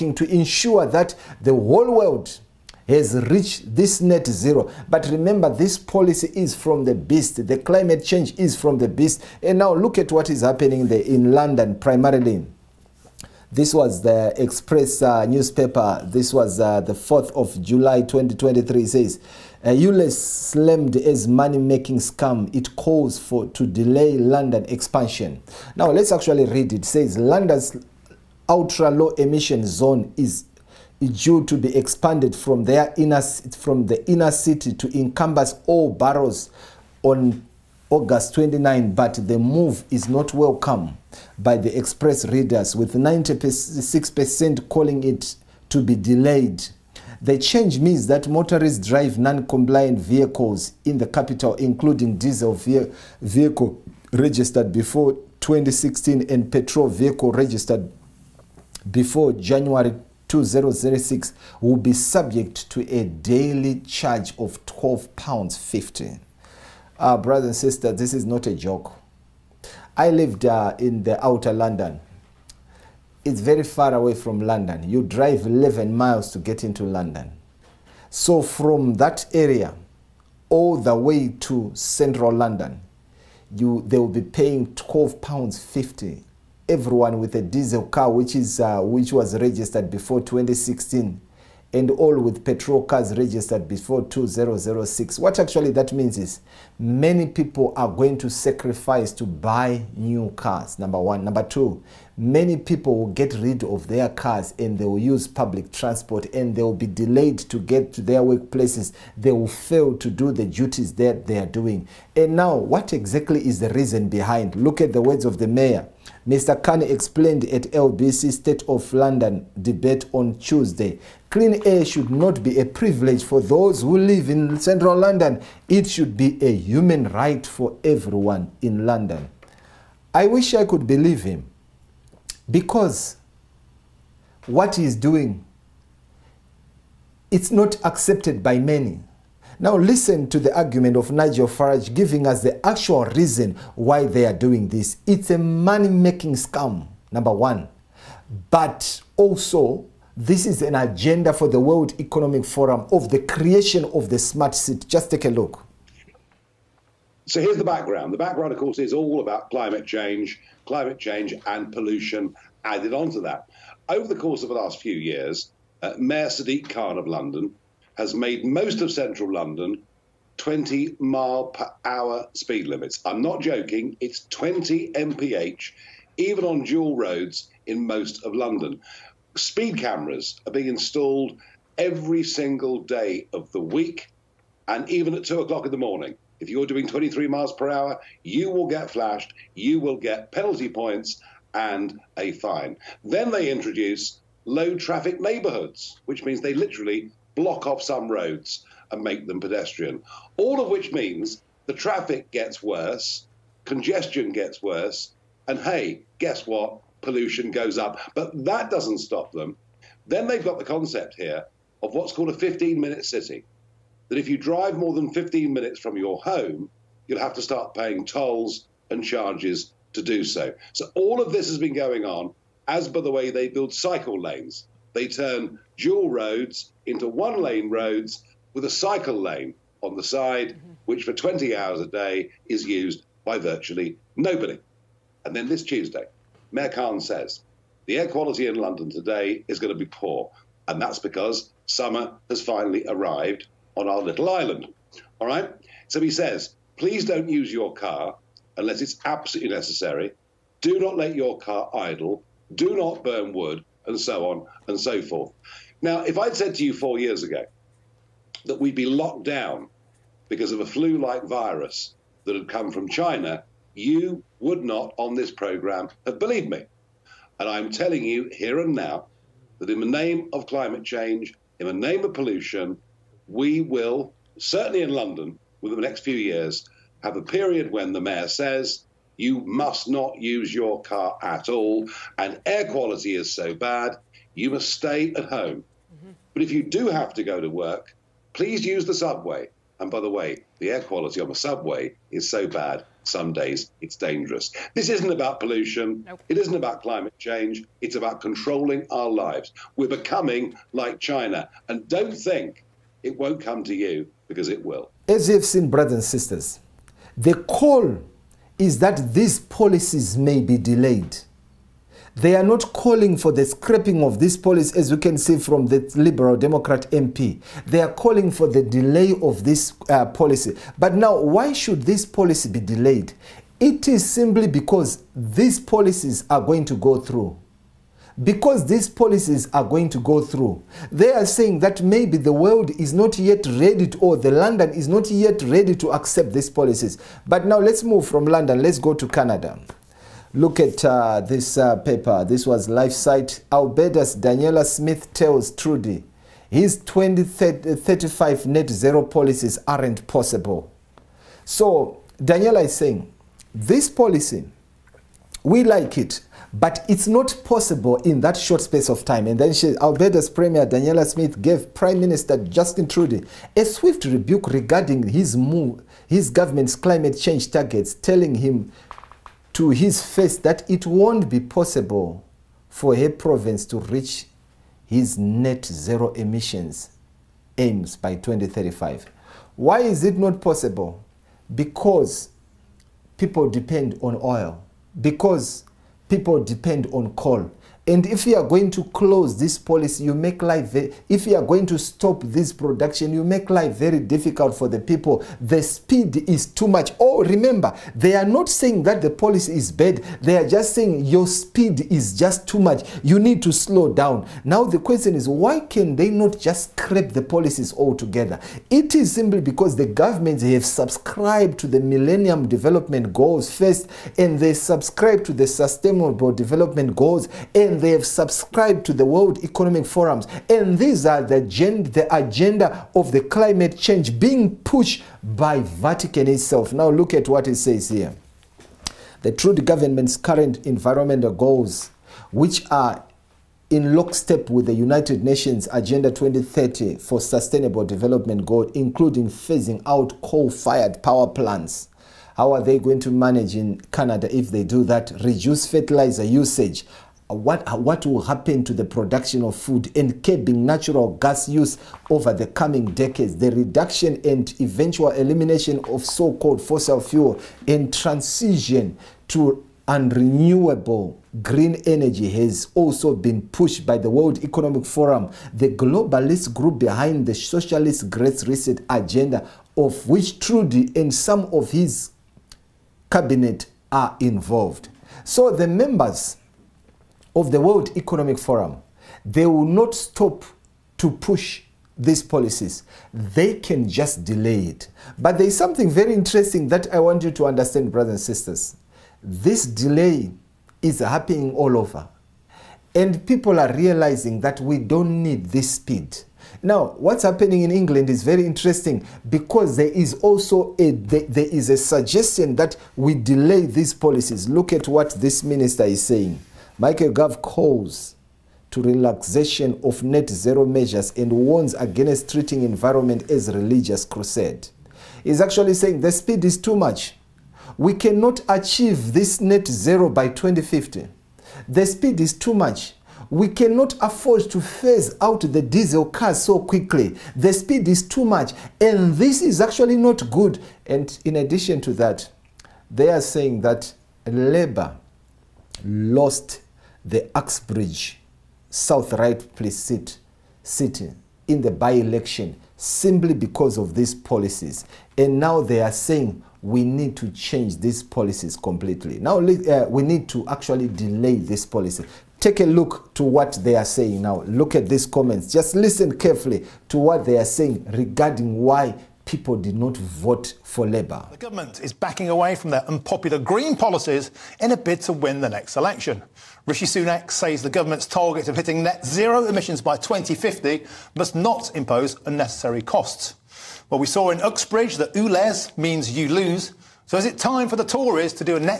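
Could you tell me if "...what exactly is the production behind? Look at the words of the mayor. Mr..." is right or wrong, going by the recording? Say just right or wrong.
wrong.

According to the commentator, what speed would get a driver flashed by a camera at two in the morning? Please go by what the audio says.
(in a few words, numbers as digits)
23 mph.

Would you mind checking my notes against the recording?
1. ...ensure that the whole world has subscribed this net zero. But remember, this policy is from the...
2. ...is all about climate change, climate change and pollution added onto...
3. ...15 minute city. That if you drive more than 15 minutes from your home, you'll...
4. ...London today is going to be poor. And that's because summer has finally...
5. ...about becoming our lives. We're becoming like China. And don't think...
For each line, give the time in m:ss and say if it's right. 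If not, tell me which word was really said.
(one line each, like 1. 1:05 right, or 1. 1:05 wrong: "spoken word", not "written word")
1. 0:00 wrong: "reached", not "subscribed"
2. 2:38 right
3. 3:32 right
4. 3:58 right
5. 4:57 wrong: "controlling", not "becoming".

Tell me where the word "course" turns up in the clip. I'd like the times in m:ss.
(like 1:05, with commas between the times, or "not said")
2:38, 2:44.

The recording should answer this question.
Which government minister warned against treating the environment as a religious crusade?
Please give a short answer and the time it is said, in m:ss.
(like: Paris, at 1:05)
Michael Gove, at 8:26.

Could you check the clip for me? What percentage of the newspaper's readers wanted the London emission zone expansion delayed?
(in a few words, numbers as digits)
96%.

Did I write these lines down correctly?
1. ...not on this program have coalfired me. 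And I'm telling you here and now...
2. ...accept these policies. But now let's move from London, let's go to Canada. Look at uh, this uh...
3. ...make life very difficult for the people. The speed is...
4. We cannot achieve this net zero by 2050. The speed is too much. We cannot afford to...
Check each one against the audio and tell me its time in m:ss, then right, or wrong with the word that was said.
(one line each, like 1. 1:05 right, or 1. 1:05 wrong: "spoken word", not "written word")
1. 4:24 wrong: "believed", not "coalfired"
2. 5:35 right
3. 6:33 right
4. 8:37 right.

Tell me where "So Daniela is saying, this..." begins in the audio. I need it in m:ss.
5:51.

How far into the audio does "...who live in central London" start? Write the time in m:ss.
2:03.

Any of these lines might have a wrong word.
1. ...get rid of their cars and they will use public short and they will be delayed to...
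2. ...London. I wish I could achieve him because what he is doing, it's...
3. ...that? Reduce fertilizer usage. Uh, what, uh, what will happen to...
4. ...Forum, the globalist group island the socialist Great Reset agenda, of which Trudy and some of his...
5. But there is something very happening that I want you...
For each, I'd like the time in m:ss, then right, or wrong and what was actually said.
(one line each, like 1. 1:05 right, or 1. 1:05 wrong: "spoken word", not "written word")
1. 1:43 wrong: "transport", not "short"
2. 2:08 wrong: "believe", not "achieve"
3. 7:24 right
4. 7:44 wrong: "behind", not "island"
5. 8:05 wrong: "interesting", not "happening".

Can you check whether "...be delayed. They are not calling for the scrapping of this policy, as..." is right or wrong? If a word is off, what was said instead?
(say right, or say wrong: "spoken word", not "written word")
right.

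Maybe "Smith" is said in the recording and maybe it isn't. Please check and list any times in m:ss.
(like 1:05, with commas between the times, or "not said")
5:44, 6:01.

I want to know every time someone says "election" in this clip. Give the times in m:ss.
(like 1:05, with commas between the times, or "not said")
9:01, 9:25.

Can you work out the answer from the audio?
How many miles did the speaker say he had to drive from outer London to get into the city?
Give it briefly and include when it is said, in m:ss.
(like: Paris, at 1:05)
11 miles, at 1:15.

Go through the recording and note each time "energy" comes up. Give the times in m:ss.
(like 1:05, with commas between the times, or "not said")
7:41.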